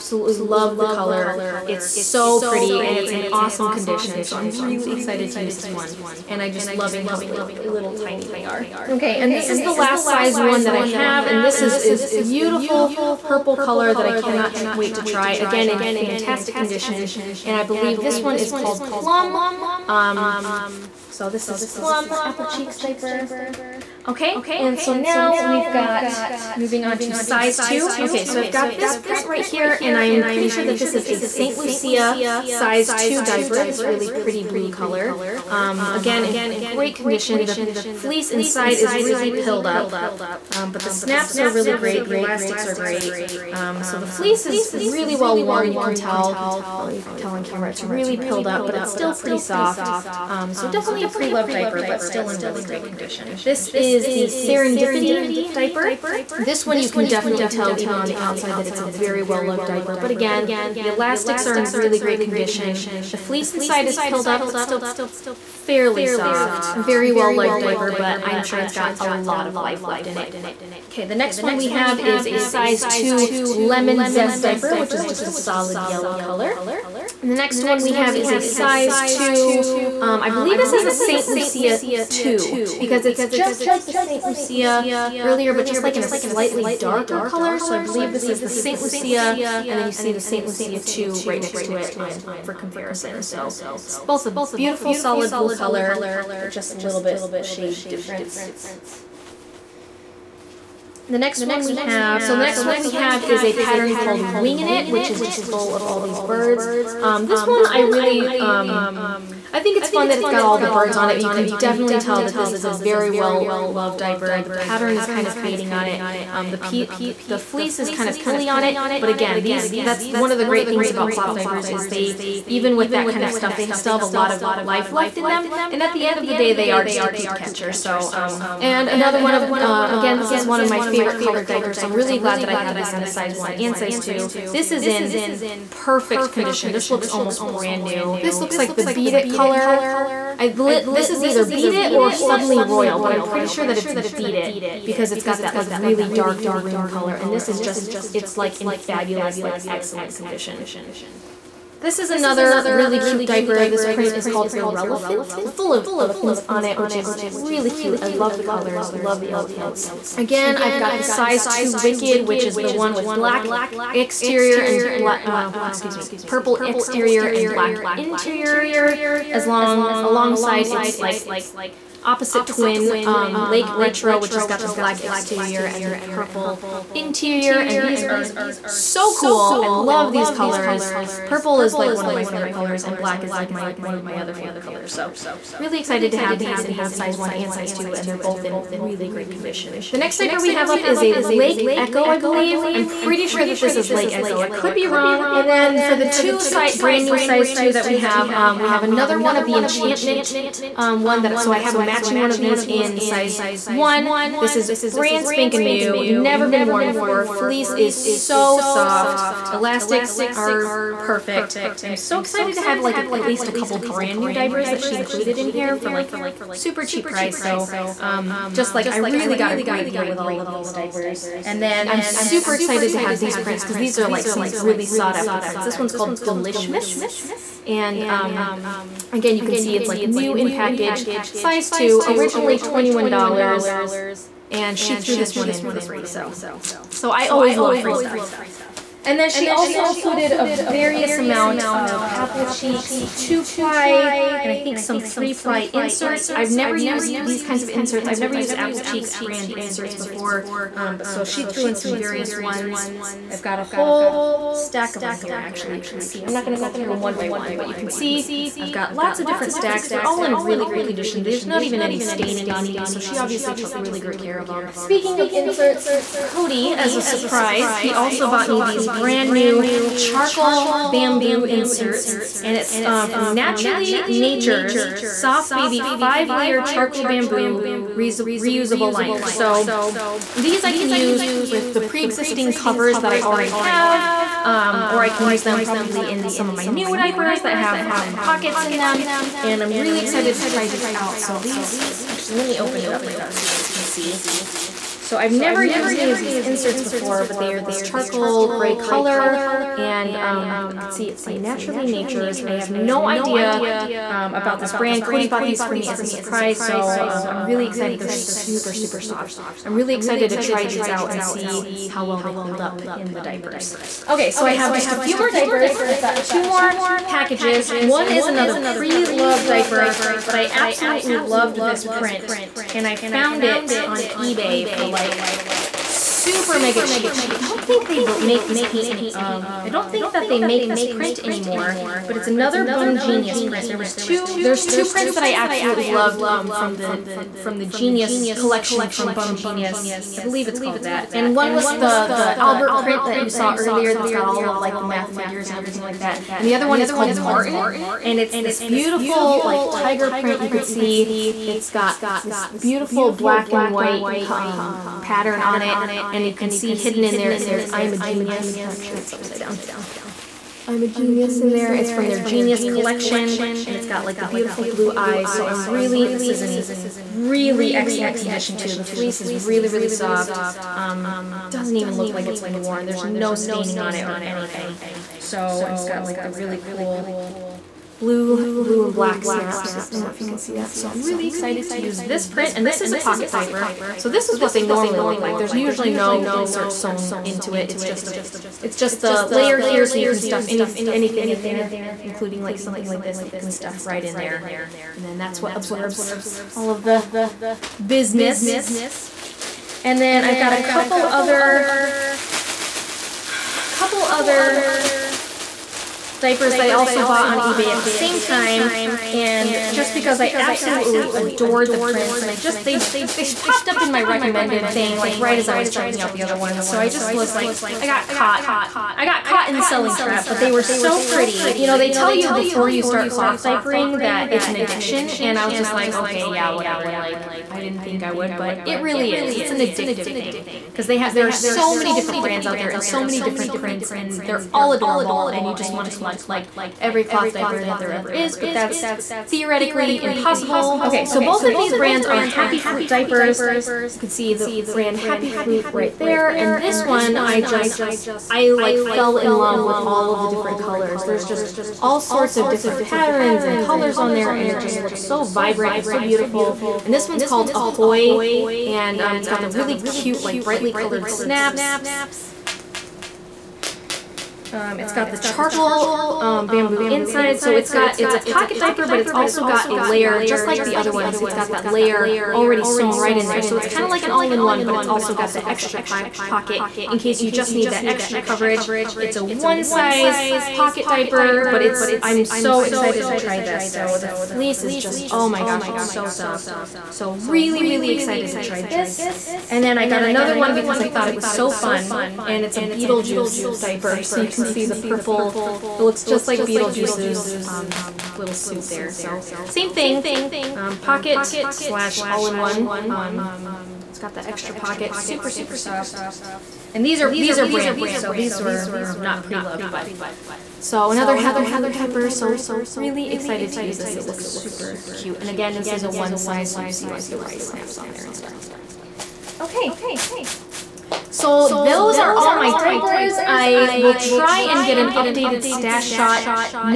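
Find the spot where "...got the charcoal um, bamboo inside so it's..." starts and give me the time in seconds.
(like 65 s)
464 s.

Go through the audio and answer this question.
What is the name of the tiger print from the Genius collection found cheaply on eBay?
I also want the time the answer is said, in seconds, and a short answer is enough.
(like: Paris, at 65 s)
Martin, at 347 s.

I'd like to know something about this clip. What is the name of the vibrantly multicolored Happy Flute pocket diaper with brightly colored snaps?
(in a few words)
Ahoy.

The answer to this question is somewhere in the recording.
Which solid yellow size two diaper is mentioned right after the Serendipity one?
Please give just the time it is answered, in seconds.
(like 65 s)
73 s.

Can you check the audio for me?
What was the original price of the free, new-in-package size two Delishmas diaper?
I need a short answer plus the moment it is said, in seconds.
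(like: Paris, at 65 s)
$21, at 232 s.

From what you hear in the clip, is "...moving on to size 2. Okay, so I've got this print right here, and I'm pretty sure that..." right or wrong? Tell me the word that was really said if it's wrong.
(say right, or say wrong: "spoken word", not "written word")
right.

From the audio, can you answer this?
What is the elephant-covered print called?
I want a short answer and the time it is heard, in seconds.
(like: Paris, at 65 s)
Irrelephant, at 154 s.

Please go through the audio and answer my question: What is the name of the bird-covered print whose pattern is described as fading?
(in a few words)
Wingin' It.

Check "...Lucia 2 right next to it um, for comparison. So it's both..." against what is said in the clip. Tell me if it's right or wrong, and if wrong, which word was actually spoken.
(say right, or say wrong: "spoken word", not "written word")
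right.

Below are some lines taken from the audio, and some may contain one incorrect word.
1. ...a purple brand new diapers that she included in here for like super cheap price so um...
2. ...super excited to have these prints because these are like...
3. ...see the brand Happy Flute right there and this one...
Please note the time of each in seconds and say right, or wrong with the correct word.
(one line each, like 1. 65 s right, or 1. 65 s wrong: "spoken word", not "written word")
1. 213 s wrong: "couple", not "purple"
2. 222 s right
3. 444 s right.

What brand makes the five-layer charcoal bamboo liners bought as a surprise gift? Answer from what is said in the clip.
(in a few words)
Naturally Natures.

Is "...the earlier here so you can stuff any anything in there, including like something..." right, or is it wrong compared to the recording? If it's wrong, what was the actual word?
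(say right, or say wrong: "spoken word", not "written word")
wrong: "layer", not "earlier".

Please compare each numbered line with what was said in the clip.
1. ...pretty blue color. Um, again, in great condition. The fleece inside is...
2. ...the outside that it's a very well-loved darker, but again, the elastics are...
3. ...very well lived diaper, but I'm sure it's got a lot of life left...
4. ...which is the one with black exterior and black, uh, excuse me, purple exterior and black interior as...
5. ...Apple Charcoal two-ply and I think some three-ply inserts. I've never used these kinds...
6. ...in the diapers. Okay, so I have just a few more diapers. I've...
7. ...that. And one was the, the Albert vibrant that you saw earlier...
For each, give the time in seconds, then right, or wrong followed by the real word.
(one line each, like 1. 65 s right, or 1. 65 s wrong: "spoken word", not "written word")
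1. 34 s right
2. 58 s wrong: "diaper", not "darker"
3. 66 s right
4. 162 s right
5. 242 s wrong: "Cheeks", not "Charcoal"
6. 312 s right
7. 340 s wrong: "print", not "vibrant".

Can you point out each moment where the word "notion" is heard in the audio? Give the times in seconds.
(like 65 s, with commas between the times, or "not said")
not said.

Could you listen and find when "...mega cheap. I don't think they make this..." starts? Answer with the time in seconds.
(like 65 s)
326 s.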